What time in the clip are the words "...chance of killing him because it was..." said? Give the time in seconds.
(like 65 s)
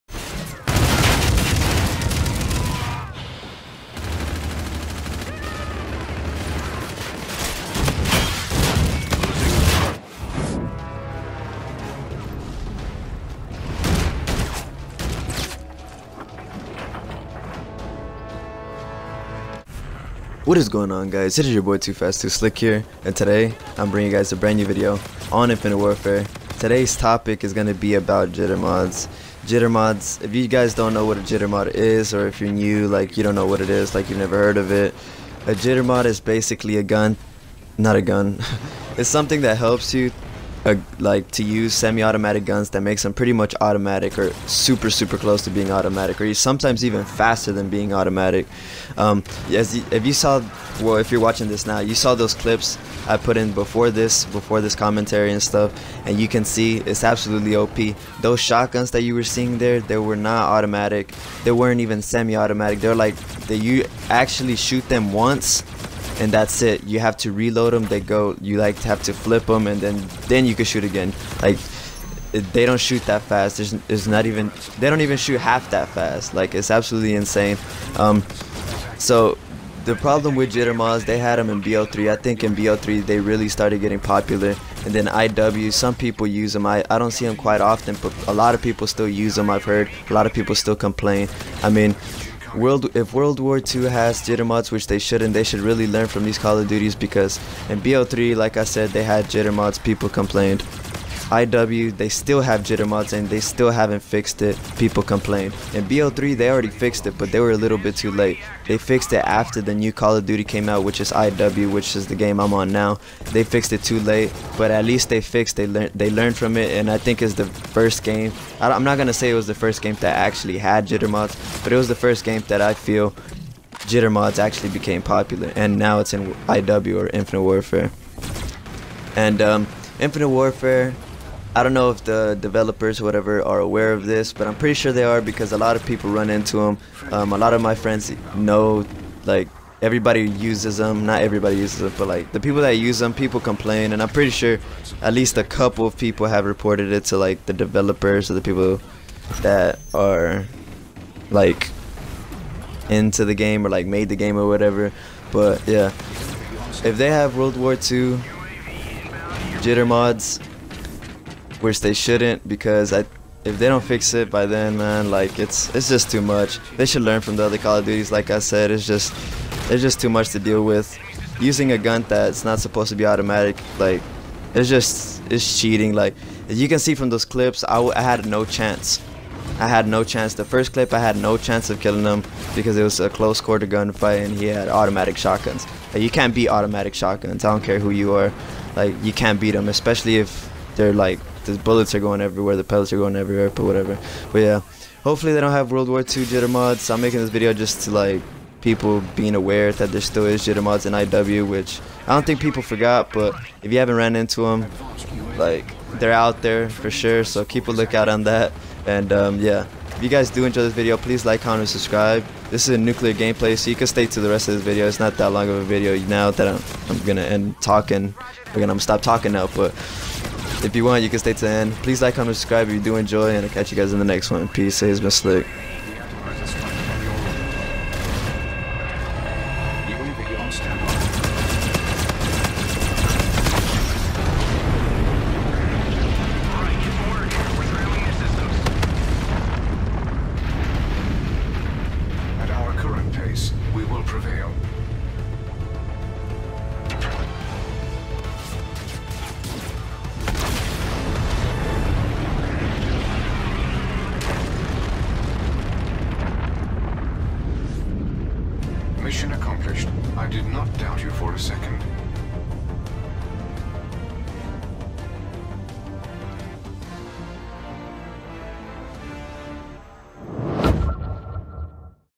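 181 s.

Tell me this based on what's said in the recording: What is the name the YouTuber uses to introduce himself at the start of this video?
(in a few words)
Too Fast Too Slick.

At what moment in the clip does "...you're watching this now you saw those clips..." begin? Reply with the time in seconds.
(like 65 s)
51 s.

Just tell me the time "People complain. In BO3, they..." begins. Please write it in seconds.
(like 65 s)
104 s.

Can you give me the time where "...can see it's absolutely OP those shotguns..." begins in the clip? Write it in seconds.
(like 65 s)
56 s.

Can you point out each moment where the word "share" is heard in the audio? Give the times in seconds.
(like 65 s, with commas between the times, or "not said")
not said.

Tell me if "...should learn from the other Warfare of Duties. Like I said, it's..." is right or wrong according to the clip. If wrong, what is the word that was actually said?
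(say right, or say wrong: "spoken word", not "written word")
wrong: "Call", not "Warfare".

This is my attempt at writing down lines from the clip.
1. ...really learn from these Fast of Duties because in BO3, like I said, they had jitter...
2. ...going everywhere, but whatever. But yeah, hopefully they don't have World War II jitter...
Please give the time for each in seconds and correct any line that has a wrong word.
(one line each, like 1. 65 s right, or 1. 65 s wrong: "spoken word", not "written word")
1. 95 s wrong: "Call", not "Fast"
2. 192 s right.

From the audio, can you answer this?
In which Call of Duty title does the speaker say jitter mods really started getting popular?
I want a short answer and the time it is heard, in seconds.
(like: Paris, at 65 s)
BO3, at 82 s.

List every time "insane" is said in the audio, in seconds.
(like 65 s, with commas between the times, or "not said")
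77 s.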